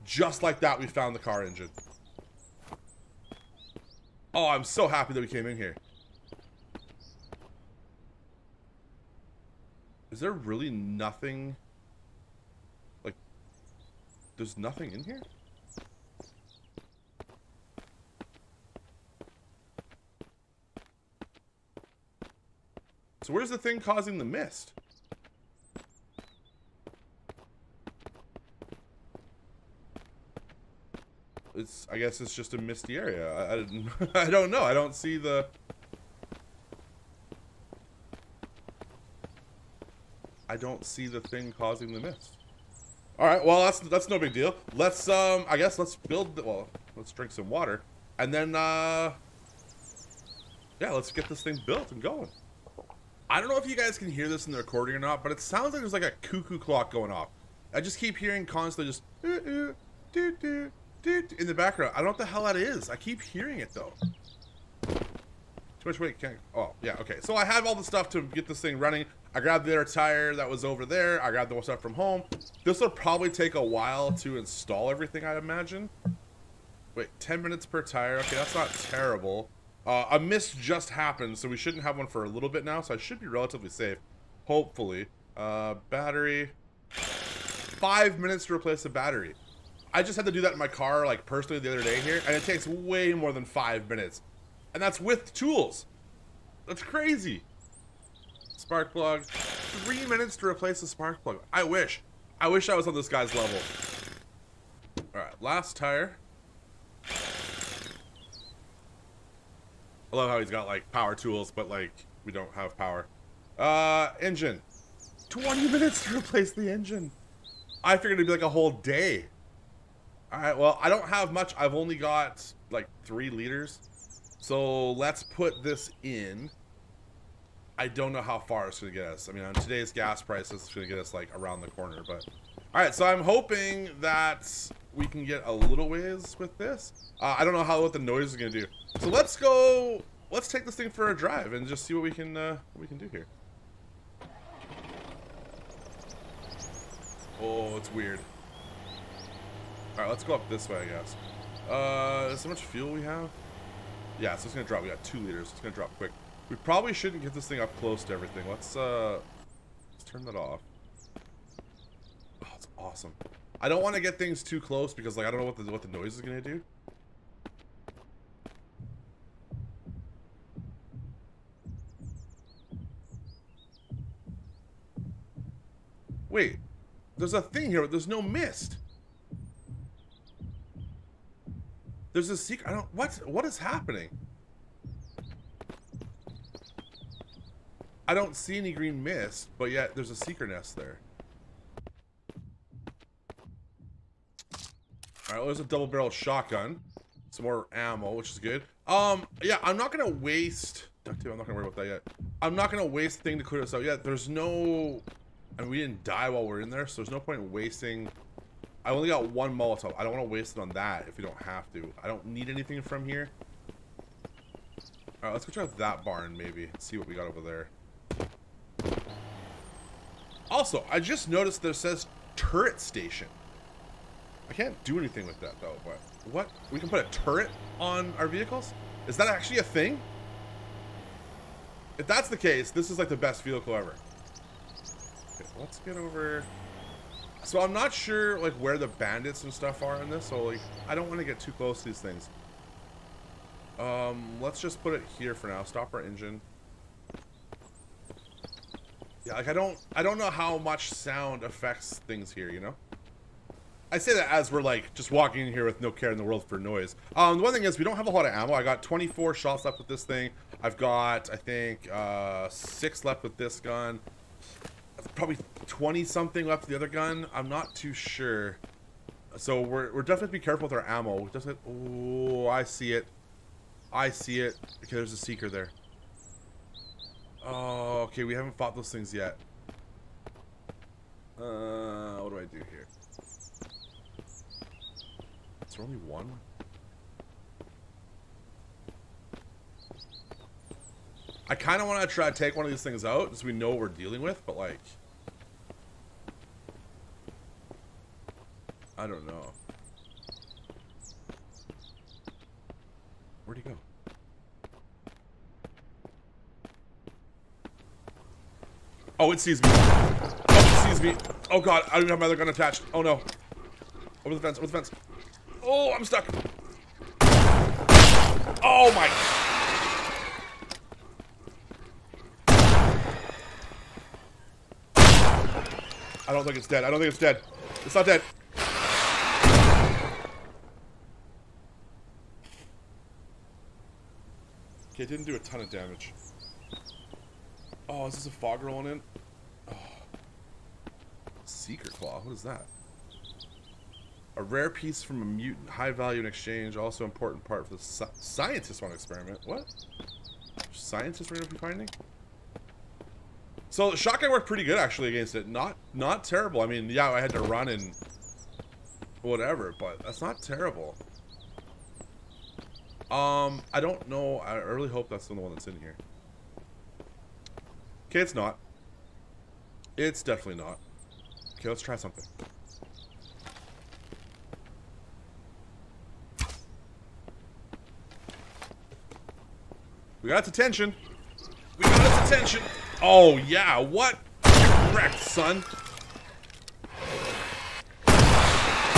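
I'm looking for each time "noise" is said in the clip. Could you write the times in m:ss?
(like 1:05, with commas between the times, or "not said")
2:17, 2:45, 4:16.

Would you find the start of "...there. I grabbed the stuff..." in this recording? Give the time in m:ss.
1:10.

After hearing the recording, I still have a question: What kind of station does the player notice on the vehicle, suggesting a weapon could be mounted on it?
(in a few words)
Turret station.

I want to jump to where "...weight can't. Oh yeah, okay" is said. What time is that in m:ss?
1:05.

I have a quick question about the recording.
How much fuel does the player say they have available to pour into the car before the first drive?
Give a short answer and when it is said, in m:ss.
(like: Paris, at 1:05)
3 liters, at 2:03.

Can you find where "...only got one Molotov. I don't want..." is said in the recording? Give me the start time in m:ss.
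3:28.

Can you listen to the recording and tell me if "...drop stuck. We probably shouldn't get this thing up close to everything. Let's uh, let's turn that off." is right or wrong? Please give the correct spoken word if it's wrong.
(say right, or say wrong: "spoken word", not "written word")
wrong: "quick", not "stuck".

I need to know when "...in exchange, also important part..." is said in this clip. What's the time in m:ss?
5:46.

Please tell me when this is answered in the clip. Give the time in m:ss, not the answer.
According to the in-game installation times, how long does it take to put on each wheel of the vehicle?
1:17.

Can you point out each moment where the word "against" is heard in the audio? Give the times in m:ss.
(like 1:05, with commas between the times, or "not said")
5:55.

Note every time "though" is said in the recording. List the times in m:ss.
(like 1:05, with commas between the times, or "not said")
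1:03, 3:45.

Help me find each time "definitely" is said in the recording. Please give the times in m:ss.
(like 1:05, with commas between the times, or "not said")
4:30, 6:10.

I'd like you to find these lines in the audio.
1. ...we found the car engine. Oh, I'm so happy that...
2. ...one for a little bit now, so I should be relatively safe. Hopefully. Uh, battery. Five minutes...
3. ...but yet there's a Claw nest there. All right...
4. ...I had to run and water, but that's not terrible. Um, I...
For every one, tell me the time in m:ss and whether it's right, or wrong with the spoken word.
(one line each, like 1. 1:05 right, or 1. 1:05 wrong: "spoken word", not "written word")
1. 0:00 right
2. 1:21 right
3. 3:09 wrong: "Seeker", not "Claw"
4. 5:57 wrong: "whatever", not "water".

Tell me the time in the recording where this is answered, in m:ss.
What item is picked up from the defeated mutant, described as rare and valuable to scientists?
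5:41.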